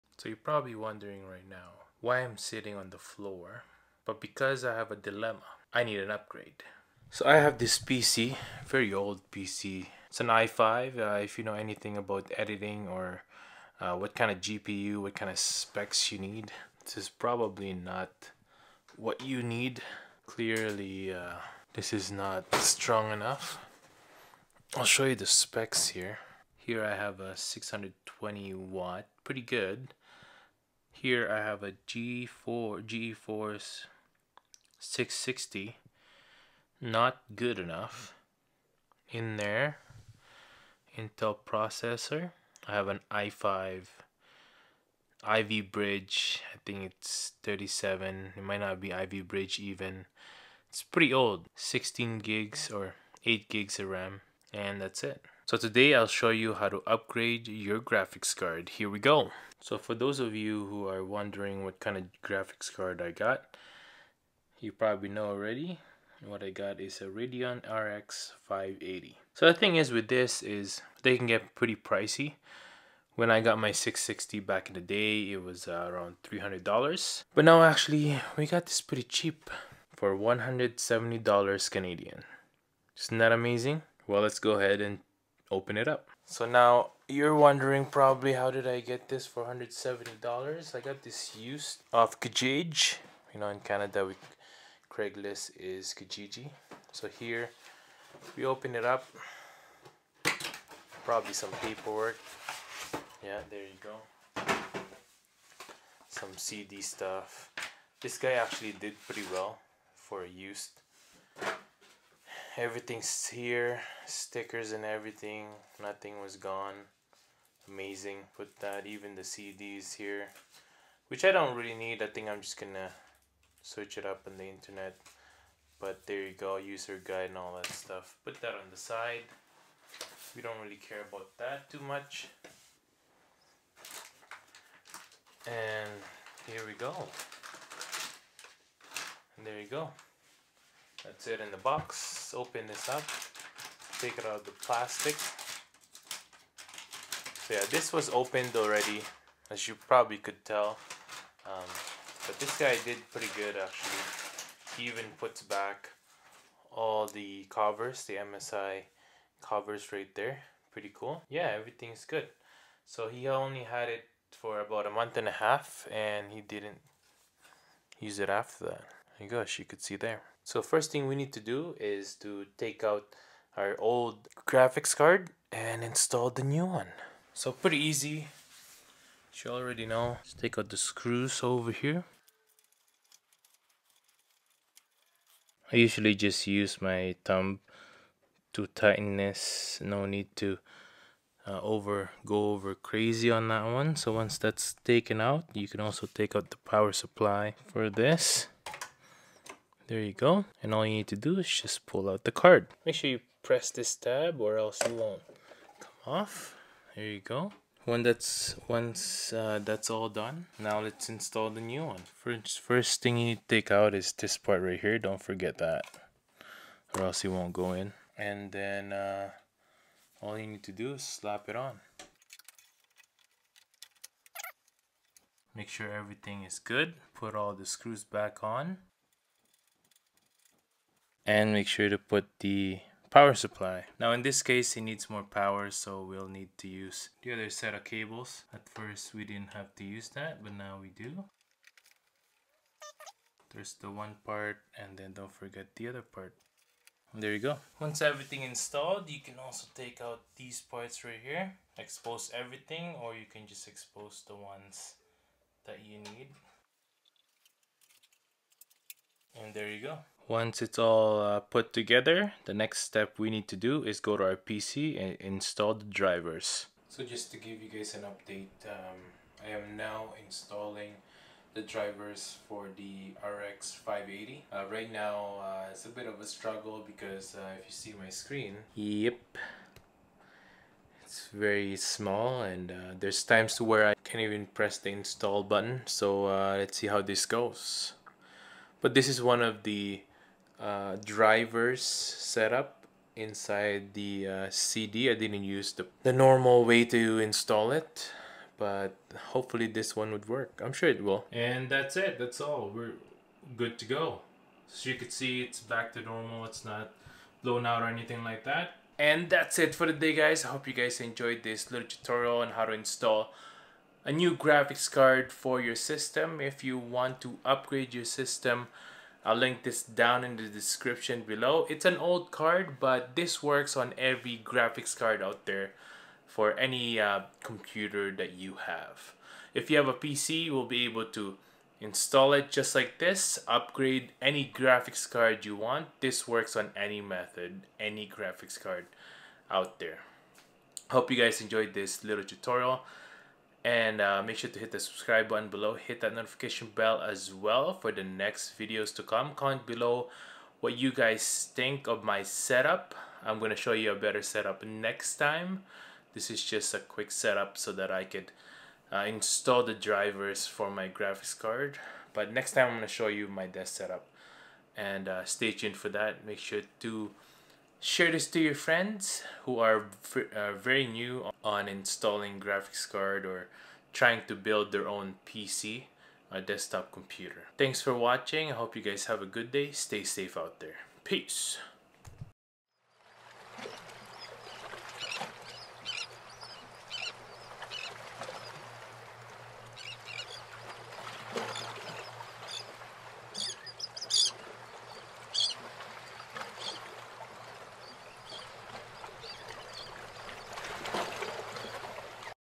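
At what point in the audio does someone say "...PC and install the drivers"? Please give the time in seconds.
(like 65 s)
264 s.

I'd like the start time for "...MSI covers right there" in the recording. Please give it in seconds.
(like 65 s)
158 s.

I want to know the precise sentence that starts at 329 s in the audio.
If you have a PC, you will be able to install it just like this, upgrade any graphics card you want.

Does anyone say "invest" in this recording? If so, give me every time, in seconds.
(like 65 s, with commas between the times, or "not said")
not said.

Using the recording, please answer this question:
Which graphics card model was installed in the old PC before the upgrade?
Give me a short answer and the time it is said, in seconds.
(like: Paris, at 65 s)
GeForce 660, at 32 s.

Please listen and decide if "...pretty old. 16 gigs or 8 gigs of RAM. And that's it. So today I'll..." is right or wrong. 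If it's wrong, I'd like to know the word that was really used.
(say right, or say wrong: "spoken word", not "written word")
right.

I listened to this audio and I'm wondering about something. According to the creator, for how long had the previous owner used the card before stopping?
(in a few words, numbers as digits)
a month and a half.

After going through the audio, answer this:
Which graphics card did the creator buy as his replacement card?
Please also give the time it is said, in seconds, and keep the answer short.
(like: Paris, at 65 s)
Radeon RX 580, at 67 s.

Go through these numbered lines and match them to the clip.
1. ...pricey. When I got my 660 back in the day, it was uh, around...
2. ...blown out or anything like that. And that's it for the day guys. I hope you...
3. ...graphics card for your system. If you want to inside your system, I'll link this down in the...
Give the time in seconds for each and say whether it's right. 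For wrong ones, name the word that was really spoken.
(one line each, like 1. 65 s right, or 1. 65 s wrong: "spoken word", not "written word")
1. 71 s right
2. 307 s right
3. 314 s wrong: "upgrade", not "inside".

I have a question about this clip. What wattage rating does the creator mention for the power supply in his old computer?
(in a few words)
620 watt.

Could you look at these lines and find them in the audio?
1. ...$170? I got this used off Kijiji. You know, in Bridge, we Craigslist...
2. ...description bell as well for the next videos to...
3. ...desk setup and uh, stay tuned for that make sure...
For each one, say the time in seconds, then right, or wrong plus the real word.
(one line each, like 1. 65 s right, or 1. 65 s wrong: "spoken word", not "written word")
1. 89 s wrong: "Canada", not "Bridge"
2. 346 s wrong: "notification", not "description"
3. 363 s right.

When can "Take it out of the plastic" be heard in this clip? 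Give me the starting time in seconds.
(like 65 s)
143 s.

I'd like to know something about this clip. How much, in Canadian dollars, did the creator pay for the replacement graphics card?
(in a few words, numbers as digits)
$170.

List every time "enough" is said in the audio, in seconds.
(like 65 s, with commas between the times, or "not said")
23 s, 37 s.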